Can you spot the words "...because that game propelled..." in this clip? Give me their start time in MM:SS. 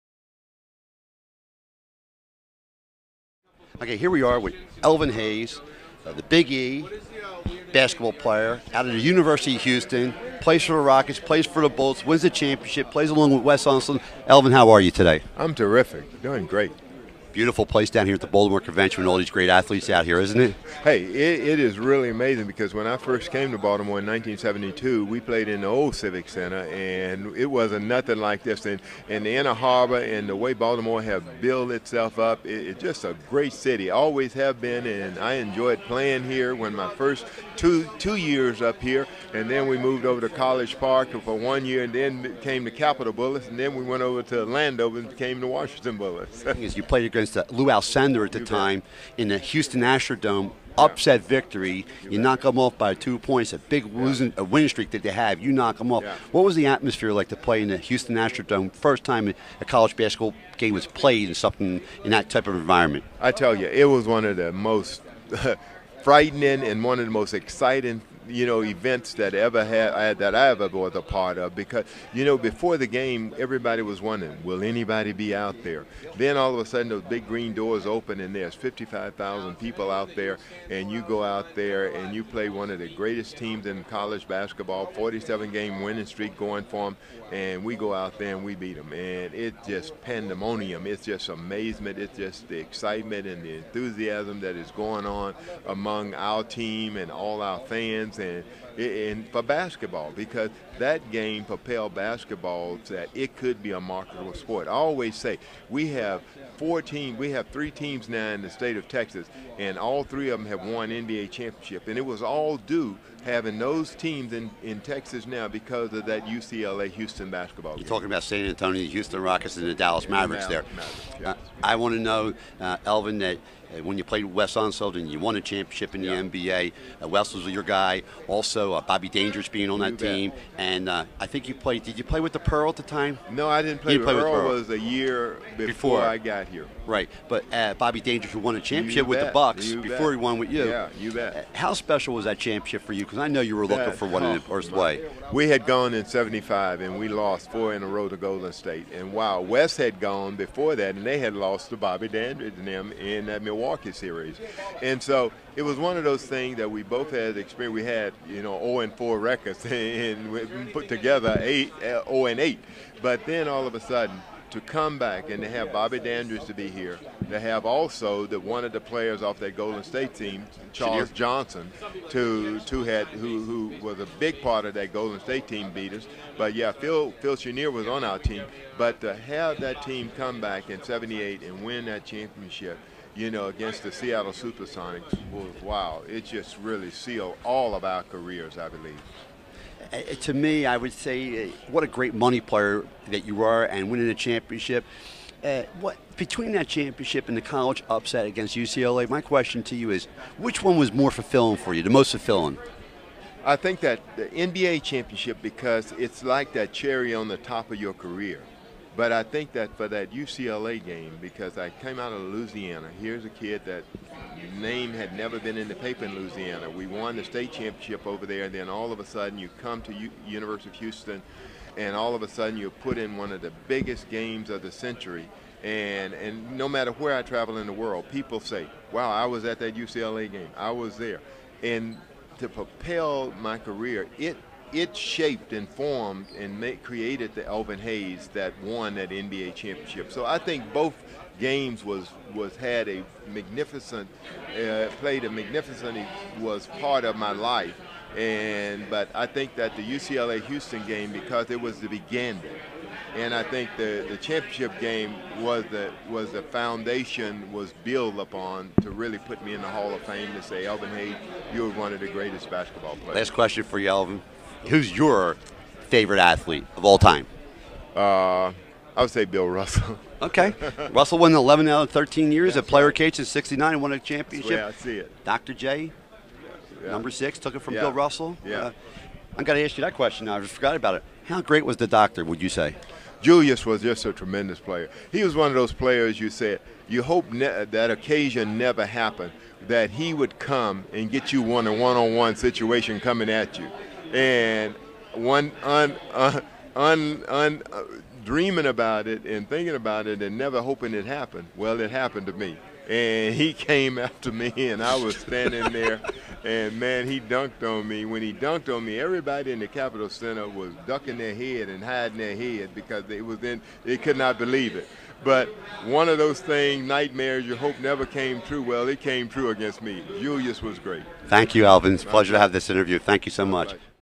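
01:40.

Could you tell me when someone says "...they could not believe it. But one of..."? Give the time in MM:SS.
05:13.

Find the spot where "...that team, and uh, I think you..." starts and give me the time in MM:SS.
02:09.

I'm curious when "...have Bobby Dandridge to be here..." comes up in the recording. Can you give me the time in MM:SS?
02:45.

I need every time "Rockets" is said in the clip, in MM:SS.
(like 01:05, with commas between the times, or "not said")
00:10, 01:59.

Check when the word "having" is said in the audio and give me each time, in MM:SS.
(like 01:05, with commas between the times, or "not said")
01:53.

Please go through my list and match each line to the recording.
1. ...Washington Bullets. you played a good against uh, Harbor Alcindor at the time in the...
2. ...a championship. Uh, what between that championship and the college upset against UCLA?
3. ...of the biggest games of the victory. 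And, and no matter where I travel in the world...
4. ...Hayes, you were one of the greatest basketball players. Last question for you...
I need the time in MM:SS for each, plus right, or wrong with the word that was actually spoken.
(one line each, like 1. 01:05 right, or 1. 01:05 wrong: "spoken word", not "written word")
1. 00:45 wrong: "Lou", not "Harbor"
2. 03:14 right
3. 03:43 wrong: "century", not "victory"
4. 04:20 right.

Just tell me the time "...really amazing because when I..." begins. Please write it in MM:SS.
00:21.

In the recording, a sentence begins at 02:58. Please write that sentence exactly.
But to have that team come back in '78 and win that championship, you know, against the Seattle SuperSonics was wow.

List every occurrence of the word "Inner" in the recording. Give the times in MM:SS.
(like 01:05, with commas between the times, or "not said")
00:29.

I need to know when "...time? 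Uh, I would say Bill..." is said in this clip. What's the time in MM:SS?
04:26.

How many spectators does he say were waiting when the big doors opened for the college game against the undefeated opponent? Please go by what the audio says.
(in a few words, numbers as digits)
55,000.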